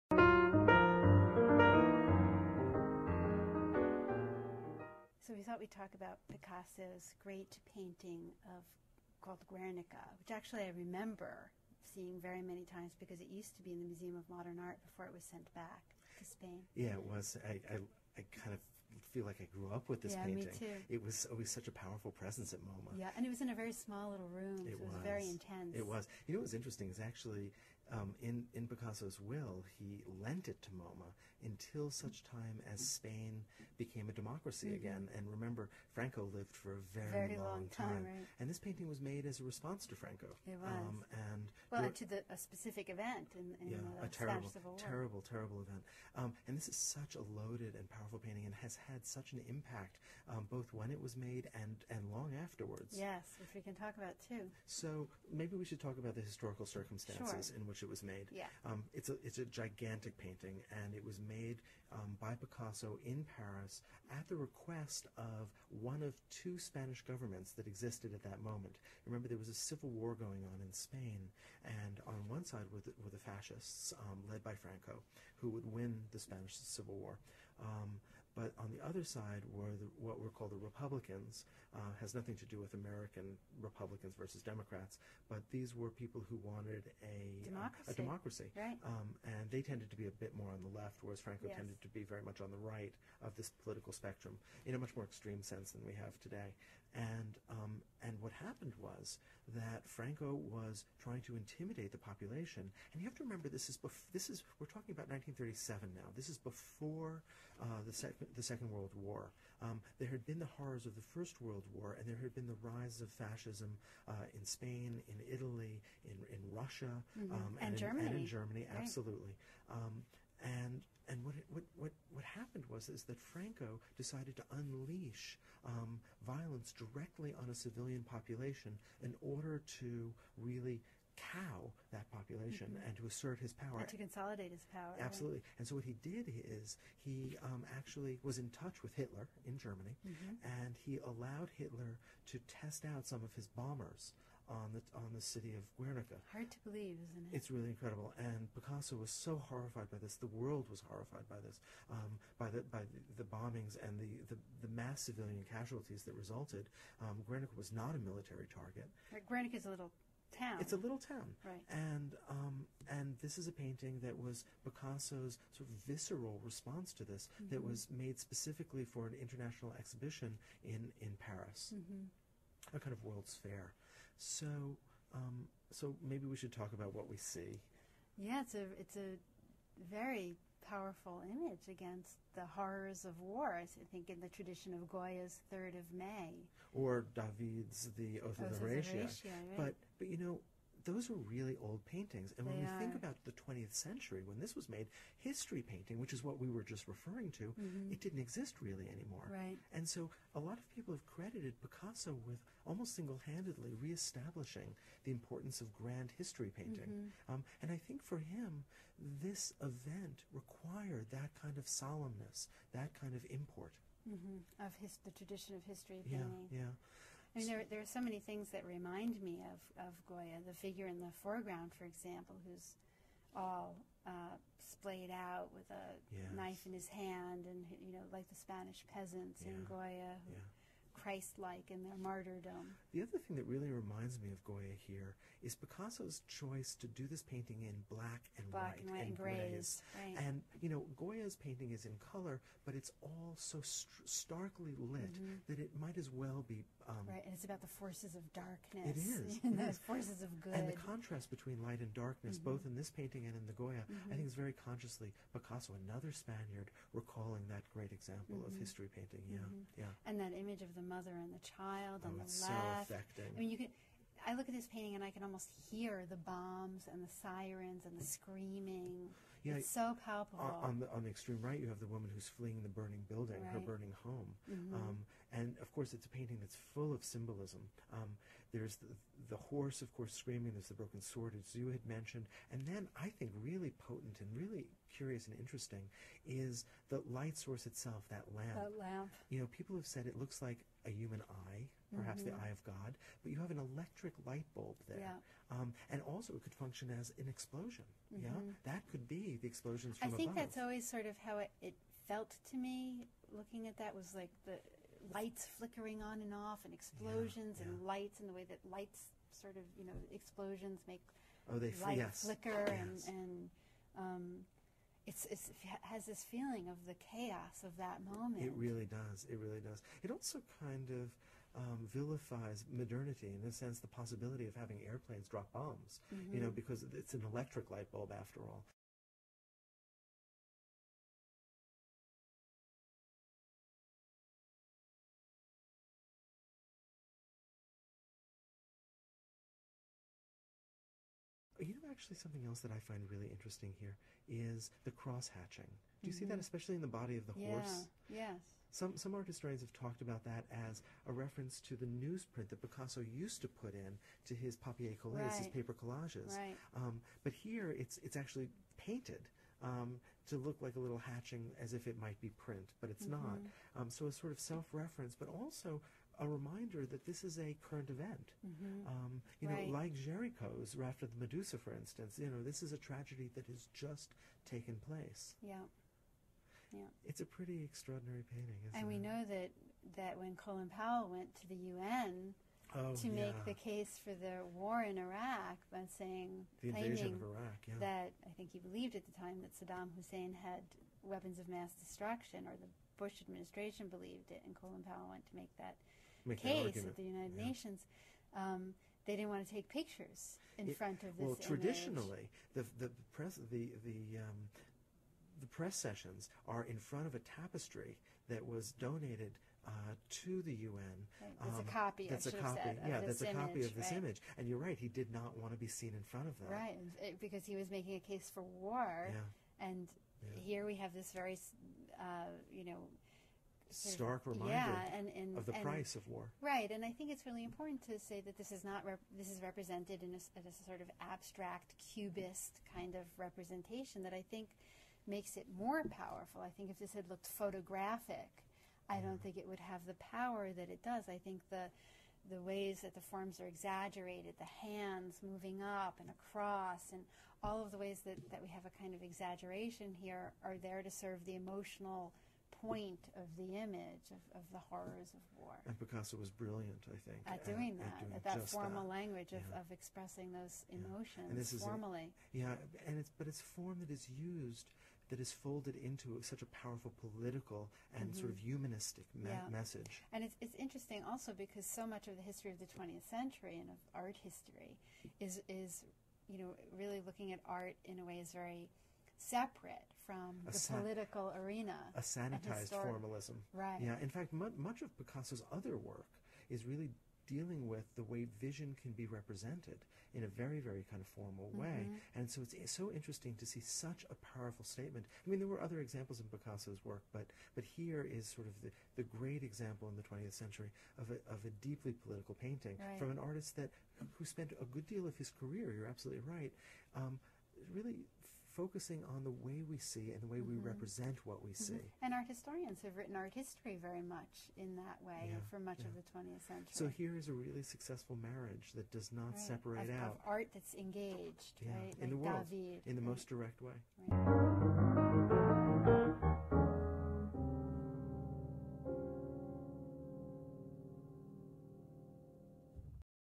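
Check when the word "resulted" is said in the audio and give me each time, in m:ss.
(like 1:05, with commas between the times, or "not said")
2:36.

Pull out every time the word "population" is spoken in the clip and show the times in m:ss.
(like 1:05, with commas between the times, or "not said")
1:41, 2:08, 2:12.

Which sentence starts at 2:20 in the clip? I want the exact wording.
and he allowed Hitler to test out some of his bombers on the on the city of Guernica.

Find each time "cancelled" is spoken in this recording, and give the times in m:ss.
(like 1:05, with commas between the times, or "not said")
not said.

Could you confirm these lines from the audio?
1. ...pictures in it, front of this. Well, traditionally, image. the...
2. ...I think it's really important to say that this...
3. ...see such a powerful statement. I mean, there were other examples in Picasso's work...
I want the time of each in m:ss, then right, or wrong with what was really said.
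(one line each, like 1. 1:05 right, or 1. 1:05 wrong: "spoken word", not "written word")
1. 6:39 right
2. 7:06 right
3. 8:13 right.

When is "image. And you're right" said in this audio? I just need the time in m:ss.
6:53.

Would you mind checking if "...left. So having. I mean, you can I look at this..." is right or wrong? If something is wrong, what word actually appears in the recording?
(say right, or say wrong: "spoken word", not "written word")
wrong: "affecting", not "having".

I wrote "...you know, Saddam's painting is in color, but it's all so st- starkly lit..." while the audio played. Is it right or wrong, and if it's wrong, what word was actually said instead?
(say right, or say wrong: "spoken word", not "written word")
wrong: "Goya", not "Saddam".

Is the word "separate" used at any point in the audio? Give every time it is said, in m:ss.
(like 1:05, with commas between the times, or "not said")
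7:59, 8:39.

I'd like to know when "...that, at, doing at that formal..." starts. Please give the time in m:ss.
7:37.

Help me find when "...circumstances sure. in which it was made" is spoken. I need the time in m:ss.
0:56.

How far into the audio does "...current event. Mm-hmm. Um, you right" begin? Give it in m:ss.
6:07.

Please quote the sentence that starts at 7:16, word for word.
I think if this had looked photographic, I don't mm.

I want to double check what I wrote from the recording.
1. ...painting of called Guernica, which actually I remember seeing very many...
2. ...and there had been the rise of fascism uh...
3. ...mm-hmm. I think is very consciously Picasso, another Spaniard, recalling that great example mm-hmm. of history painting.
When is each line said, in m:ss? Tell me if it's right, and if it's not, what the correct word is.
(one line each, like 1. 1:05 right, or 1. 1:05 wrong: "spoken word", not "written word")
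1. 0:07 right
2. 1:51 right
3. 4:13 right.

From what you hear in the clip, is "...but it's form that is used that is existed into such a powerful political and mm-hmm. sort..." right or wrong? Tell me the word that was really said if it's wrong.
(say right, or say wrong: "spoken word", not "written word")
wrong: "folded", not "existed".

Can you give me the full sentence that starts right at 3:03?
I think in the tradition of Goya's Third of May, or David's The Oath, Oath of the Horatii.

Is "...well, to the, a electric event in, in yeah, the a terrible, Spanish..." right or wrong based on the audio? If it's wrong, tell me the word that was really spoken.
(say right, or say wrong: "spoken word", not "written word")
wrong: "specific", not "electric".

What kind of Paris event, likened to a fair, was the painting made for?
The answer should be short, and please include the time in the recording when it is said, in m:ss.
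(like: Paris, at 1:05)
An international exhibition, at 2:49.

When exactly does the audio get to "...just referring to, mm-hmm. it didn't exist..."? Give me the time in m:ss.
3:16.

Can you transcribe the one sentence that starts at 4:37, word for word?
Um, there's the, the horse, of course, screaming.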